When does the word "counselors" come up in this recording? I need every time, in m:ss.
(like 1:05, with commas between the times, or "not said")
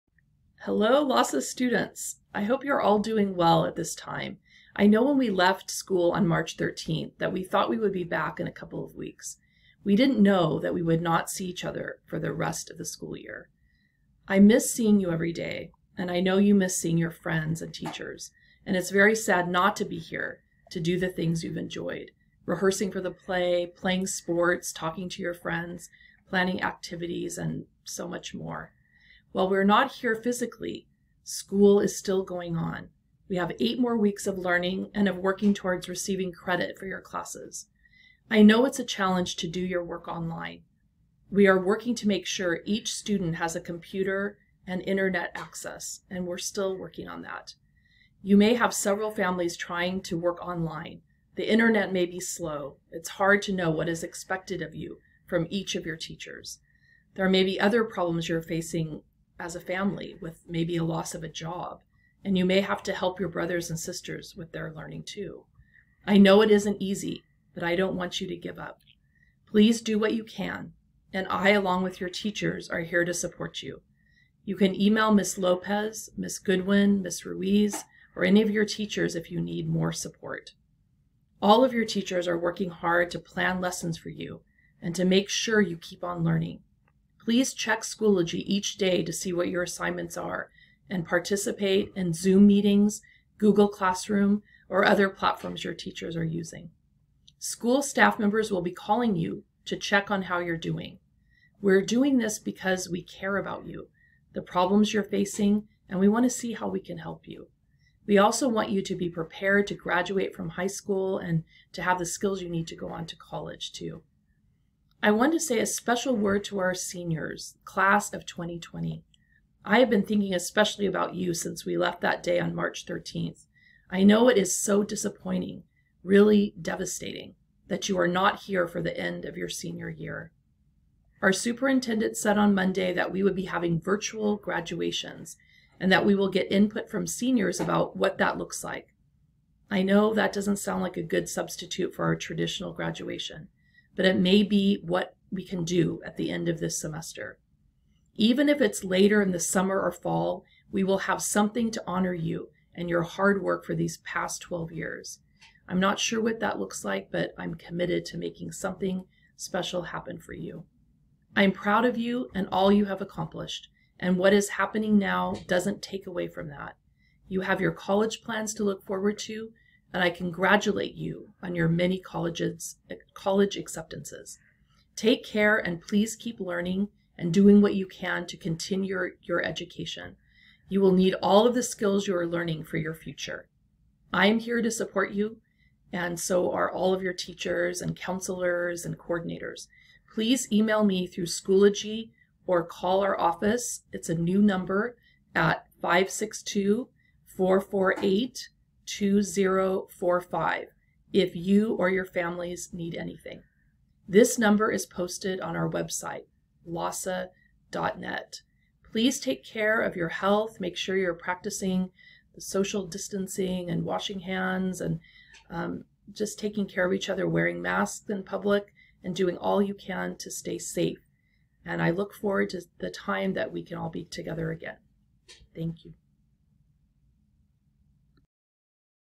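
3:07.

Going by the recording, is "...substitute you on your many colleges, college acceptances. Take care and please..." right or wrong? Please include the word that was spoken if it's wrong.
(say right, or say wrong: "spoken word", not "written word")
wrong: "congratulate", not "substitute".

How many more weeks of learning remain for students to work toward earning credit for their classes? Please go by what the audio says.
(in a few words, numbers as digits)
8.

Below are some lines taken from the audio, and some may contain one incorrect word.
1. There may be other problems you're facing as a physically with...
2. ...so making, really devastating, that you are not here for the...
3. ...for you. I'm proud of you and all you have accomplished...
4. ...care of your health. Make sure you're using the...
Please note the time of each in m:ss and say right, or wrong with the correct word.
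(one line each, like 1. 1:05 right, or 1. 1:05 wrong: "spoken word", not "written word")
1. 0:57 wrong: "family", not "physically"
2. 2:04 wrong: "disappointing", not "making"
3. 2:40 right
4. 3:29 wrong: "practicing", not "using".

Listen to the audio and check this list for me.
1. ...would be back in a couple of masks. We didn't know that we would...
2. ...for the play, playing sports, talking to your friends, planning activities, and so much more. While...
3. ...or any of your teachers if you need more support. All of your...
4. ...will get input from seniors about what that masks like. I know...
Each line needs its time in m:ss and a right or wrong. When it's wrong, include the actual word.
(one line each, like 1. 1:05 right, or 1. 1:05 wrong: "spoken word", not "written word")
1. 0:07 wrong: "weeks", not "masks"
2. 0:22 right
3. 1:18 right
4. 2:16 wrong: "looks", not "masks".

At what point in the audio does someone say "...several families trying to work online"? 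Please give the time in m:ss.
0:48.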